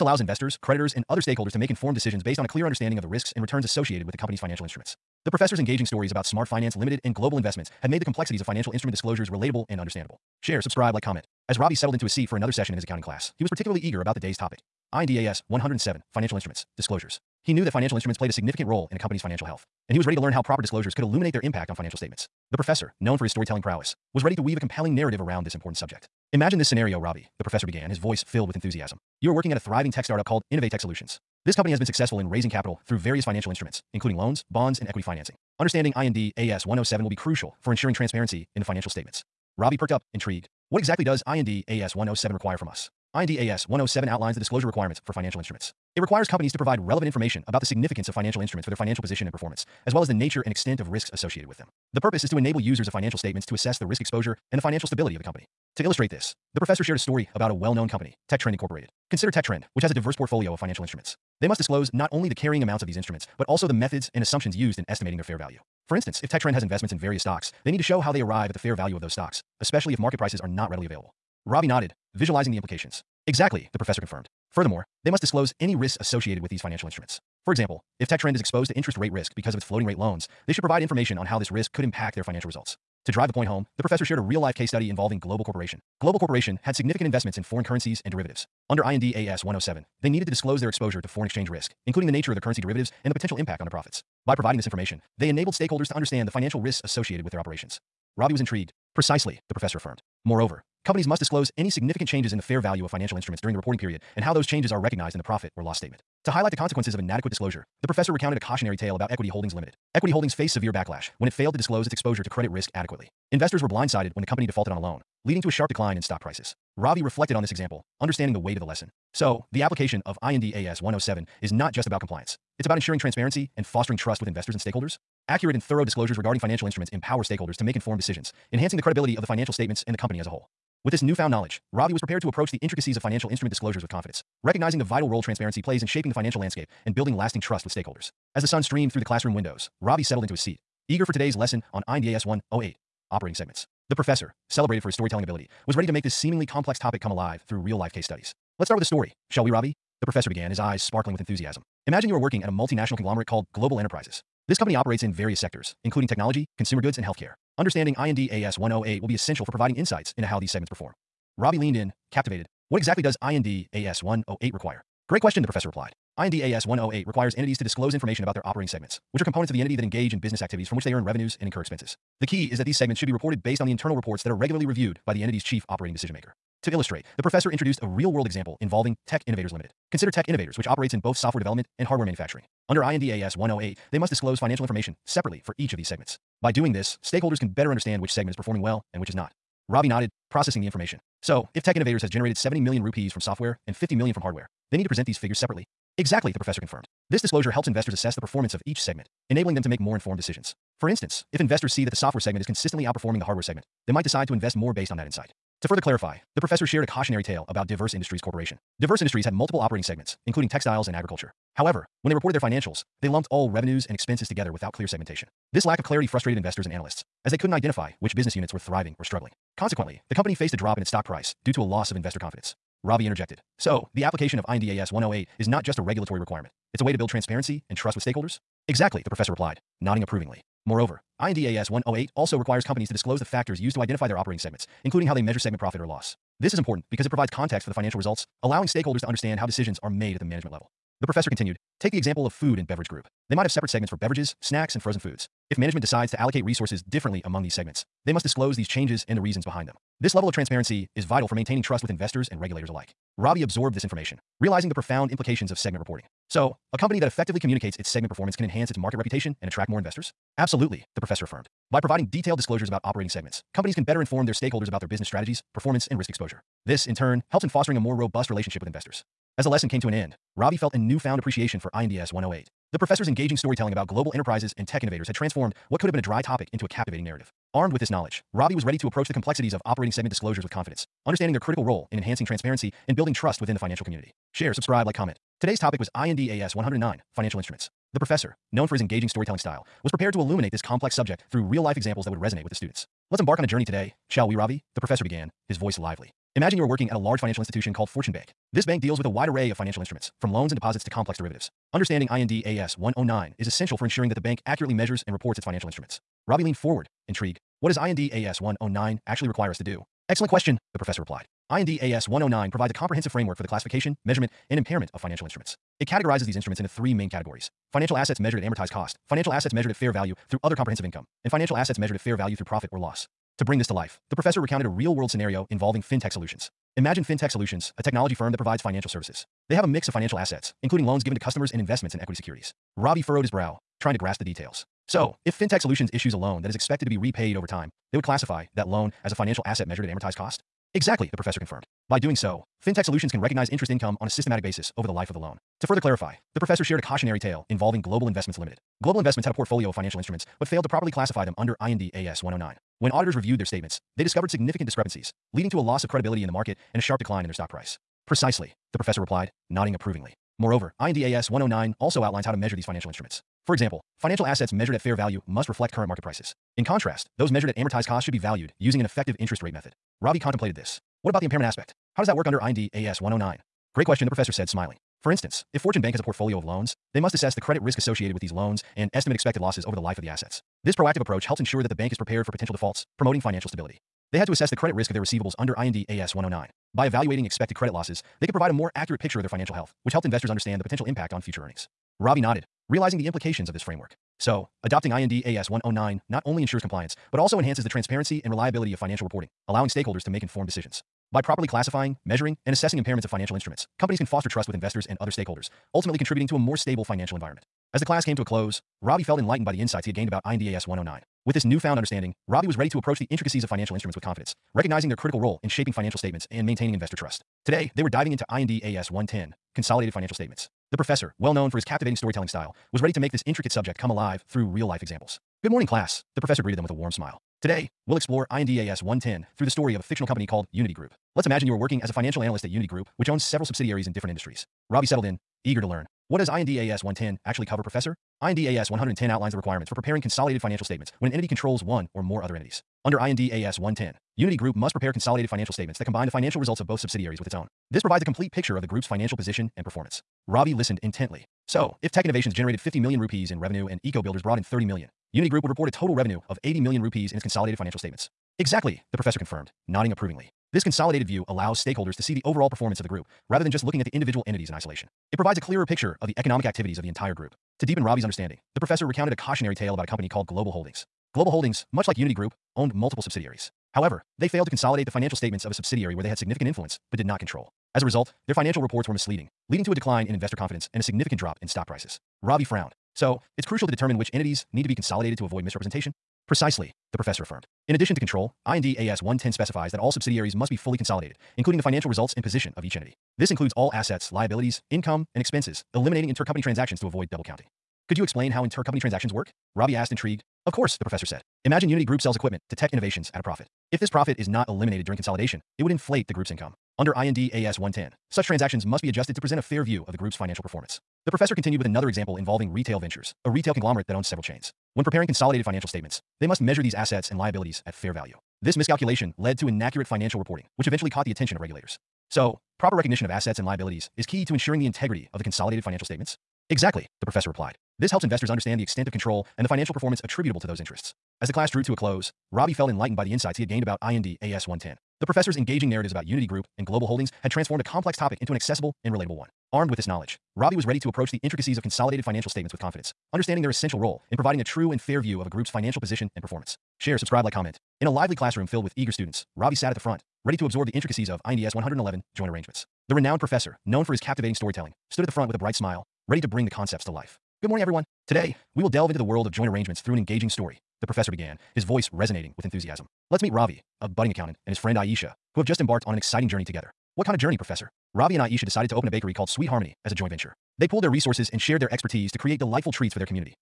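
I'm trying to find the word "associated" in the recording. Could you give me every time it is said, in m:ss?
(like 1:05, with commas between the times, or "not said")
0:03, 0:51, 1:15, 1:36, 6:17.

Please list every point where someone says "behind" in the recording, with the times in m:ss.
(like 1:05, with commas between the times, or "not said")
4:09.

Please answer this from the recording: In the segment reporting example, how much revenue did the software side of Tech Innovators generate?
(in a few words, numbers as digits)
70 million rupees.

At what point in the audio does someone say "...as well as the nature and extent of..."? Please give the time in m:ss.
0:49.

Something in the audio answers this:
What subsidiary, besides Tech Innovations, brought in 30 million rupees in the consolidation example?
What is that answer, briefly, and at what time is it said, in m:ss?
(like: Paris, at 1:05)
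EcoBuilders, at 7:33.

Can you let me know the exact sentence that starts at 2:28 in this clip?
Let's start with a story, shall we, Ravi?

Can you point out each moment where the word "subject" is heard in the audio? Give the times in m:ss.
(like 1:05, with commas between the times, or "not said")
0:25, 4:50, 7:03.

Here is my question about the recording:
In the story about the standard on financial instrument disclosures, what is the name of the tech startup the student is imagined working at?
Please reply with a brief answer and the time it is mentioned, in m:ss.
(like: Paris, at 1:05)
Innovatech Solutions, at 0:30.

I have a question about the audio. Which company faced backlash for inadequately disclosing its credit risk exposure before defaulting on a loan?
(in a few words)
Equity Holdings Limited.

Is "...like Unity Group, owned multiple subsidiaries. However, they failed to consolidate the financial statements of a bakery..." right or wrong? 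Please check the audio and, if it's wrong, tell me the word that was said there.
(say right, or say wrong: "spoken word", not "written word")
wrong: "subsidiary", not "bakery".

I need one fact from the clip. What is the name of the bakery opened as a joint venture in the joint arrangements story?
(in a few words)
Sweet Harmony.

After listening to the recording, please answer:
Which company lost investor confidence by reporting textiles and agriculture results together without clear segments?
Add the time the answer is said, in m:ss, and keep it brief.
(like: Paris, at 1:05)
Diverse Industries Corporation, at 3:27.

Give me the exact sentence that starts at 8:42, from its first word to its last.
So, proper recognition of assets and liabilities is key to ensuring the integrity of the consolidated financial statements?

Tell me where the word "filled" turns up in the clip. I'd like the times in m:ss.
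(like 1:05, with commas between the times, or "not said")
0:28, 9:08.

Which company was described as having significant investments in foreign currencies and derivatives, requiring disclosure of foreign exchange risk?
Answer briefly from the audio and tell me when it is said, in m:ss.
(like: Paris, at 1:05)
Global Corporation, at 1:26.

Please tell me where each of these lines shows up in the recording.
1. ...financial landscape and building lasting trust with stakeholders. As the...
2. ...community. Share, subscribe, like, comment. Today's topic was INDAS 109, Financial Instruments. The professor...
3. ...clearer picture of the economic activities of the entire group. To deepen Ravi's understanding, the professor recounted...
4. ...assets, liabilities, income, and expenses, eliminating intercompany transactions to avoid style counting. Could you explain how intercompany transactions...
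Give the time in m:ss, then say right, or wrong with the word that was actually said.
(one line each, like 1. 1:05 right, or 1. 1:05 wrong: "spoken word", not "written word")
1. 2:16 right
2. 4:43 right
3. 7:45 right
4. 8:13 wrong: "double", not "style".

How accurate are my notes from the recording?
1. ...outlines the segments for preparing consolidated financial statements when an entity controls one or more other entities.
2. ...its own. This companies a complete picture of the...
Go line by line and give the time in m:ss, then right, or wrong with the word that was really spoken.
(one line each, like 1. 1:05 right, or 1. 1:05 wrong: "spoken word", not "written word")
1. 7:19 wrong: "requirements", not "segments"
2. 7:27 wrong: "provides", not "companies".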